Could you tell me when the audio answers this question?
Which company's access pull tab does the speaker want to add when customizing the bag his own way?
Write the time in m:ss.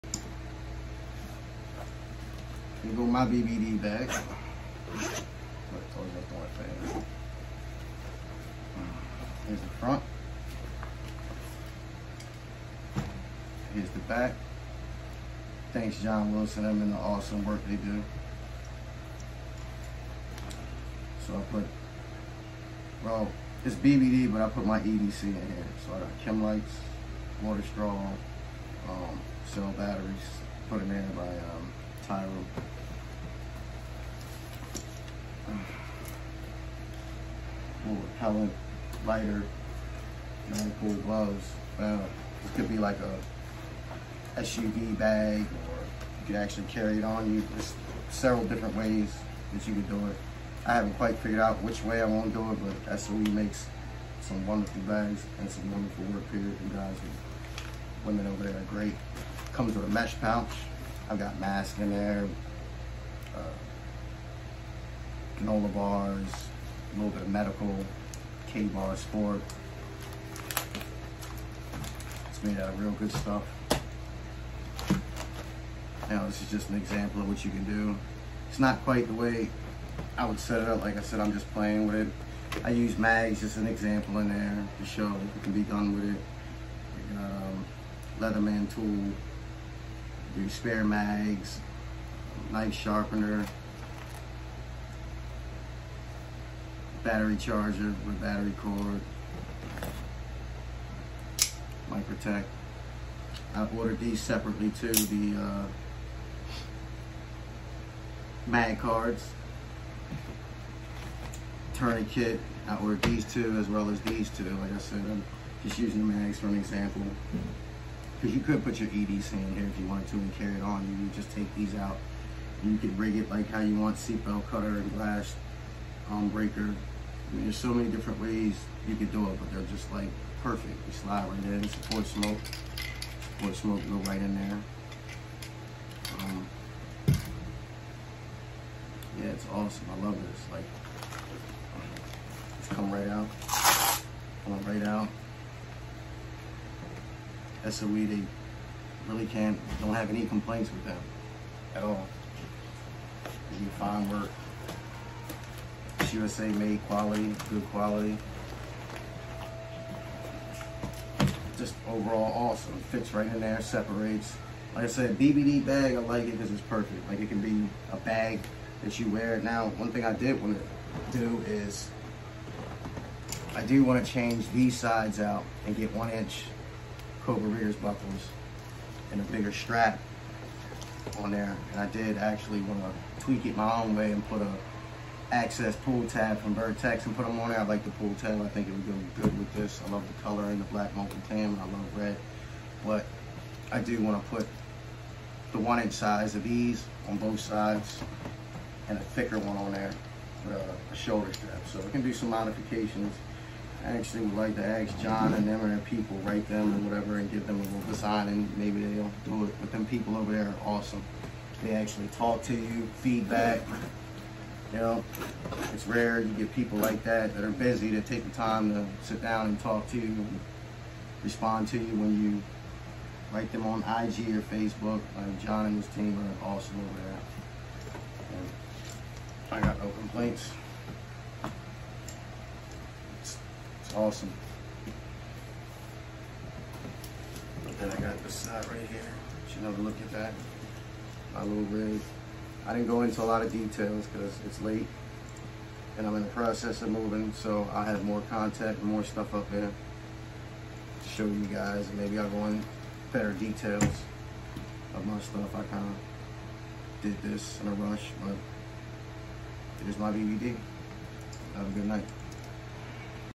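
3:06.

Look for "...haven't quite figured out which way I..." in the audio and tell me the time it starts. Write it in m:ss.
0:50.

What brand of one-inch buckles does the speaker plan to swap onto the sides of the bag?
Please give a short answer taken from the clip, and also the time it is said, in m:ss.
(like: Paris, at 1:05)
Cobra, at 2:57.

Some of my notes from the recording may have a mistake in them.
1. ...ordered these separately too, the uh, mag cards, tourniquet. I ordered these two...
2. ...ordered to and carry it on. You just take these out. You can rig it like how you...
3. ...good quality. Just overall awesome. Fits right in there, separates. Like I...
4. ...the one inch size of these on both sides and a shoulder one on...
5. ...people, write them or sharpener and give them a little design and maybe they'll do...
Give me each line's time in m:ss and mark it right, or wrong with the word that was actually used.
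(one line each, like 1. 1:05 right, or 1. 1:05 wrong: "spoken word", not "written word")
1. 1:43 right
2. 1:59 wrong: "wanted", not "ordered"
3. 2:37 right
4. 3:15 wrong: "thicker", not "shoulder"
5. 3:25 wrong: "whatever", not "sharpener".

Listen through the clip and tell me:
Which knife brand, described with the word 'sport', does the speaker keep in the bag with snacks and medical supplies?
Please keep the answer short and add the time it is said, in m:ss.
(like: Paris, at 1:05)
KA-BAR, at 1:08.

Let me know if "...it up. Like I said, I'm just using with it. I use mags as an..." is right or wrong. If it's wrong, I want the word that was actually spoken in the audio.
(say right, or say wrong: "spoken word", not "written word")
wrong: "playing", not "using".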